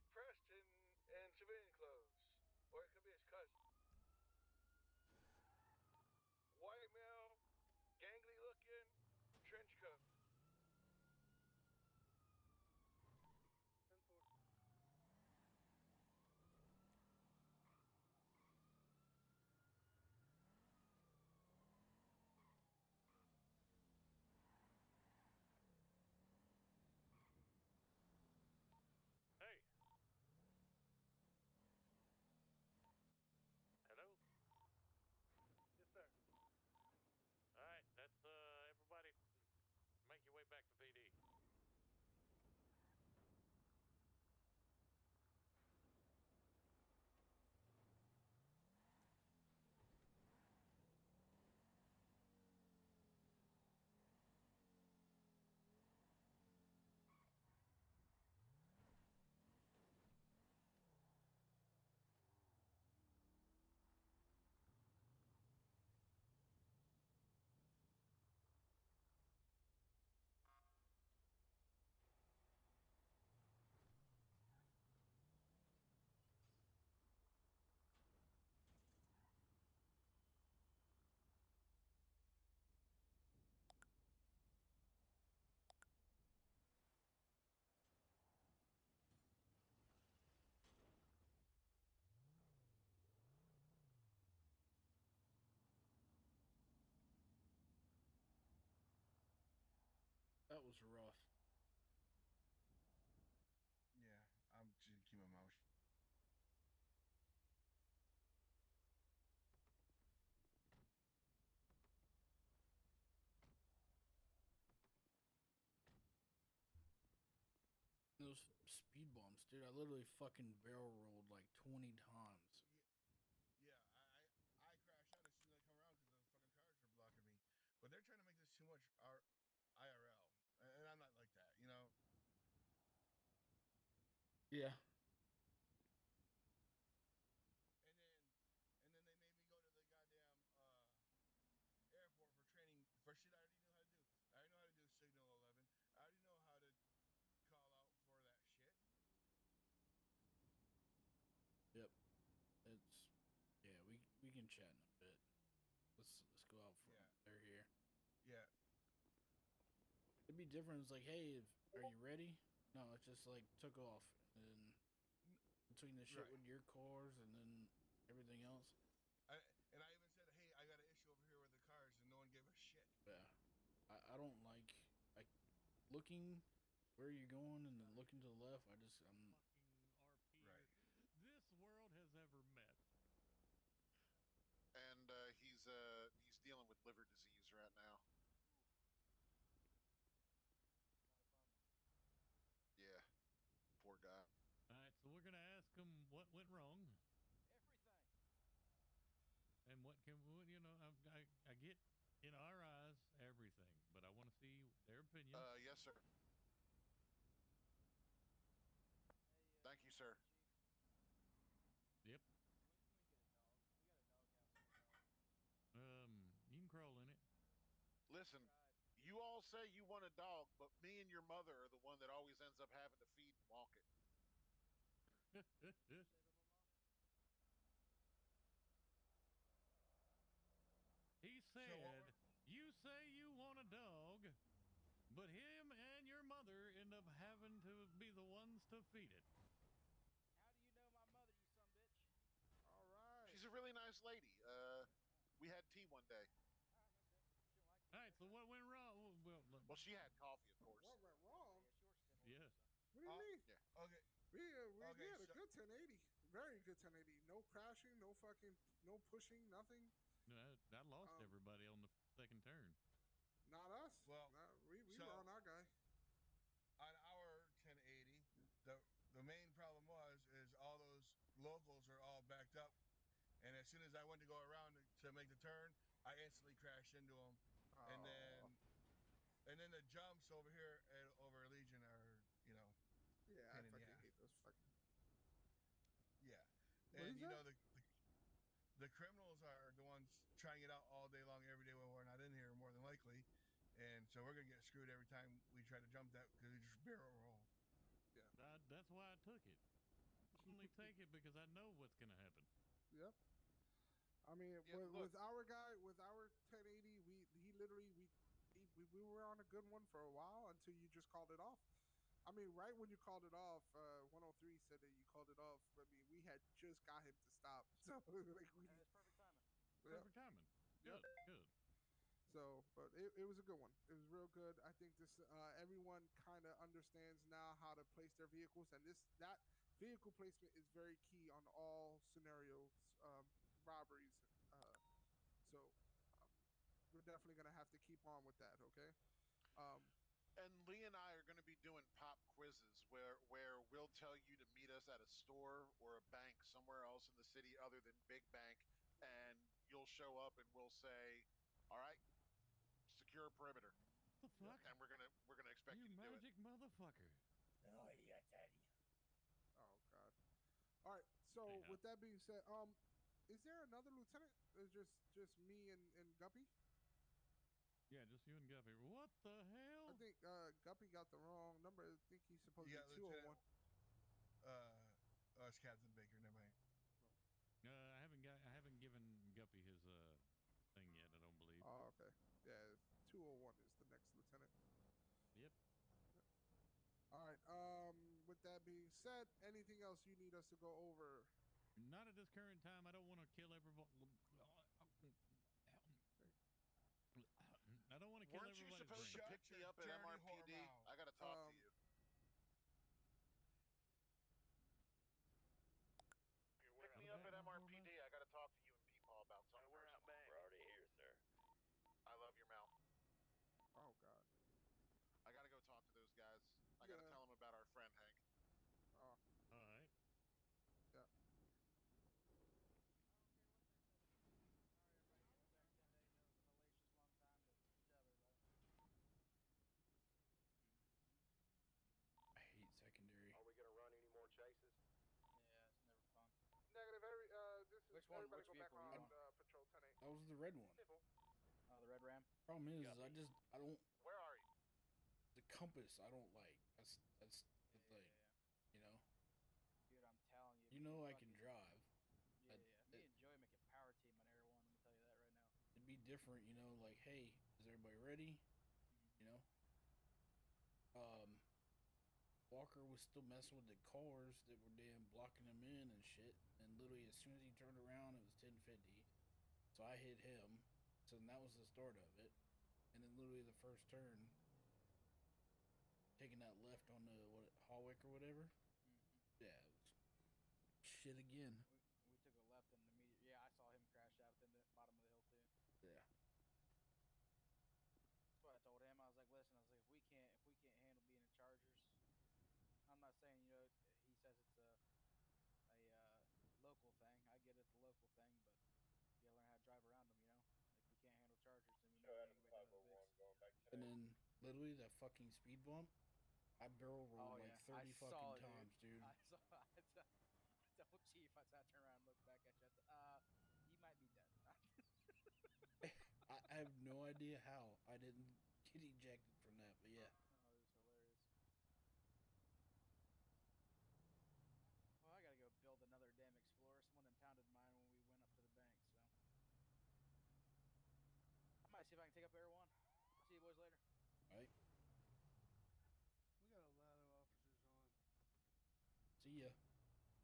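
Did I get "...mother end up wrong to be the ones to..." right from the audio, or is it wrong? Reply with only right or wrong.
wrong.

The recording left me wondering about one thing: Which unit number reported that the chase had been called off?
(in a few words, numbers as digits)
103.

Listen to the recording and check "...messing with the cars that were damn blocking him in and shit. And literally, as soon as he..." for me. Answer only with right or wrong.
right.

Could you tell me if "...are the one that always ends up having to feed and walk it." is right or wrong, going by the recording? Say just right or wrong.
right.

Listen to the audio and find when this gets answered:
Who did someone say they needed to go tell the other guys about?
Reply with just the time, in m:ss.
6:57.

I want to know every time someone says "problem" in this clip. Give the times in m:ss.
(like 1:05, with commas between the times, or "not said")
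4:29, 7:22.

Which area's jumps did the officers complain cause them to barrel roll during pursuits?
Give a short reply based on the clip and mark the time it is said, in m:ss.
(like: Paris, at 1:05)
Legion, at 4:41.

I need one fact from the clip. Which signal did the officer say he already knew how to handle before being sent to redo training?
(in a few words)
Signal 11.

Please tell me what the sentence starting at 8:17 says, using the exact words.
I get it's a local thing, but you gotta learn how to drive around them.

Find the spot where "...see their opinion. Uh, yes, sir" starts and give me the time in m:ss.
3:24.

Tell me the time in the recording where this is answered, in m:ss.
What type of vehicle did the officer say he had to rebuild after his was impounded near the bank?
8:46.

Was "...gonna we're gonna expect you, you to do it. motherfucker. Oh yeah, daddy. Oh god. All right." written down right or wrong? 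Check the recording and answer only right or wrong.
right.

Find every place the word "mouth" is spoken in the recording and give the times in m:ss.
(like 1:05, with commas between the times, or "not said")
1:45, 6:52.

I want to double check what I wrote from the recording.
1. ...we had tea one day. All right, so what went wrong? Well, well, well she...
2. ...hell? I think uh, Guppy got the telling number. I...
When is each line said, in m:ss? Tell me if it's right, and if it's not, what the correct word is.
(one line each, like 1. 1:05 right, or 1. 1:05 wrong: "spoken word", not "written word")
1. 4:05 right
2. 6:09 wrong: "wrong", not "telling".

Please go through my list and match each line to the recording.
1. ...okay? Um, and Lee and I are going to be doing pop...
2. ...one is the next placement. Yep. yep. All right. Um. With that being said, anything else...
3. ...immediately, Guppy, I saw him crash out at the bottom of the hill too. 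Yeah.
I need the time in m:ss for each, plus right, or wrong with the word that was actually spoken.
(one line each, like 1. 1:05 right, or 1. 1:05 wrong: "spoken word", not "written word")
1. 5:38 right
2. 6:23 wrong: "lieutenant", not "placement"
3. 8:02 wrong: "Yeah", not "Guppy".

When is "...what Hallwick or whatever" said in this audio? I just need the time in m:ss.
7:57.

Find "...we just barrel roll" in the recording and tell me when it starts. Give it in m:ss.
4:56.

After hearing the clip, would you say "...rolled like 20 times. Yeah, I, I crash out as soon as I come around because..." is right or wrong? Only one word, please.
right.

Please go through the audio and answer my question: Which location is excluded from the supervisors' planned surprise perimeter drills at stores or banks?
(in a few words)
Big Bank.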